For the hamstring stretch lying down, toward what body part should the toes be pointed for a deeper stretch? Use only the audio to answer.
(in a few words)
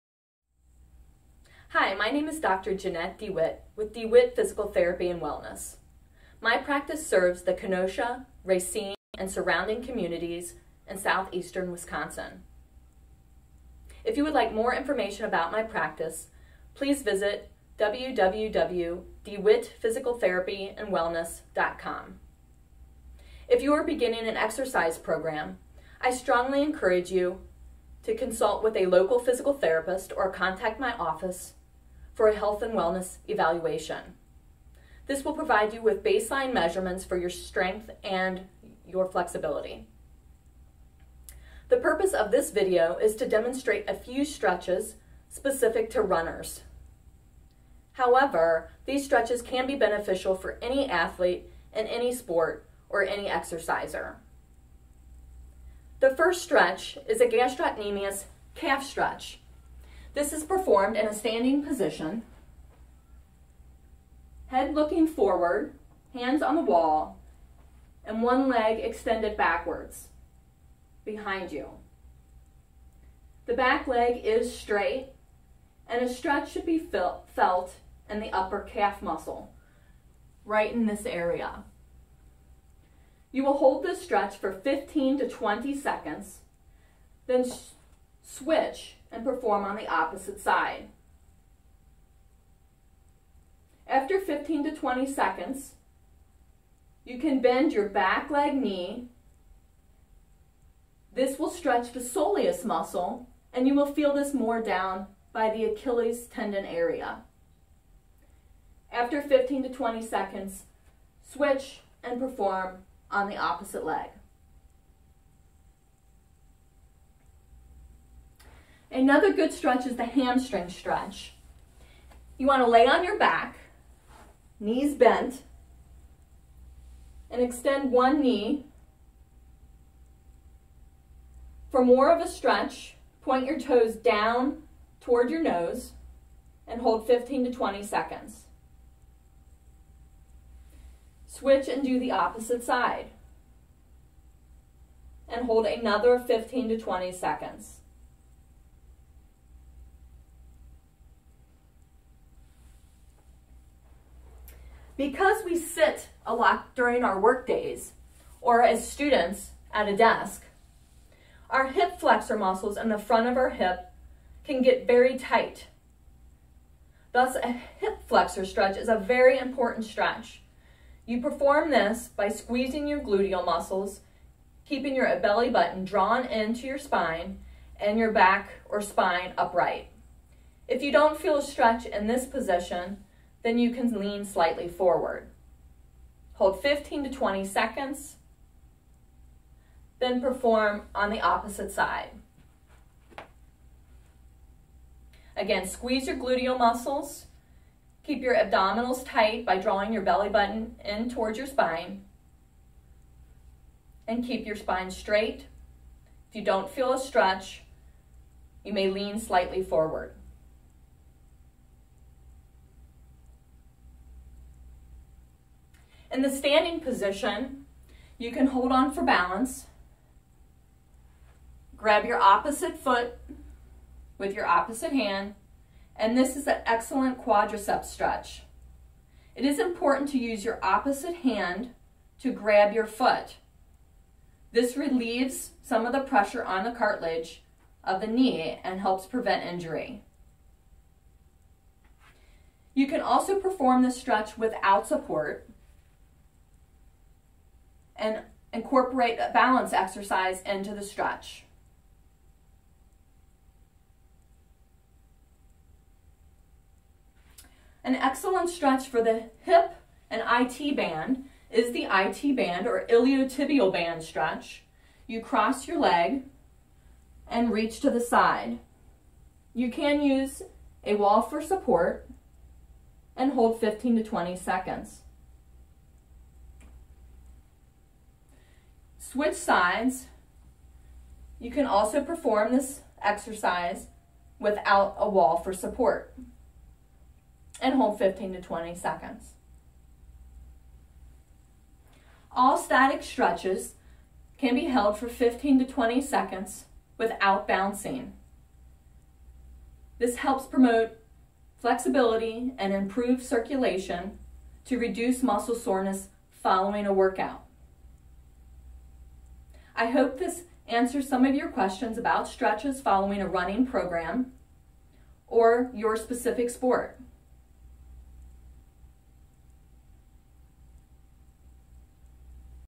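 Nose.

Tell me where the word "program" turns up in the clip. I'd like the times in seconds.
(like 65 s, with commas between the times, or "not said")
24 s, 313 s.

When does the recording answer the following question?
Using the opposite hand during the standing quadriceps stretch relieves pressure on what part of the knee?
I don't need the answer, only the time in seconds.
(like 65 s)
236 s.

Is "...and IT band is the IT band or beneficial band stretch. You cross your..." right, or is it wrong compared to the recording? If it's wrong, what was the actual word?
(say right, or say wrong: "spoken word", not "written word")
wrong: "iliotibial", not "beneficial".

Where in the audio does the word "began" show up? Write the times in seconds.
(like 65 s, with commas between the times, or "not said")
not said.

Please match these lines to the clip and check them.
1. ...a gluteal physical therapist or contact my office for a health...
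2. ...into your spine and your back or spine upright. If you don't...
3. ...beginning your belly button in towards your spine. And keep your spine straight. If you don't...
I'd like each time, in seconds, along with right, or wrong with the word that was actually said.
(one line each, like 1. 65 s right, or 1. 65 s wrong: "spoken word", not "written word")
1. 28 s wrong: "local", not "gluteal"
2. 176 s right
3. 199 s wrong: "drawing", not "beginning".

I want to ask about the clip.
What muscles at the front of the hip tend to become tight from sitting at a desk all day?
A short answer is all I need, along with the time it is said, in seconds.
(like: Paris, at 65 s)
Hip flexor muscles, at 161 s.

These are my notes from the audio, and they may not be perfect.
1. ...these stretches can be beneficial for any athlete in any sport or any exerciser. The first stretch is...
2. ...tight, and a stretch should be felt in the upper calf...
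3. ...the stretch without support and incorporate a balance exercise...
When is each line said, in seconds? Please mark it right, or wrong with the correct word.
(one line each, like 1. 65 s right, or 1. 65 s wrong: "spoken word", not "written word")
1. 48 s right
2. 74 s wrong: "straight", not "tight"
3. 243 s right.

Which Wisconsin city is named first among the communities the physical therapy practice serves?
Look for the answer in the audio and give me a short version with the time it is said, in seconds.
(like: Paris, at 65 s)
Kenosha, at 7 s.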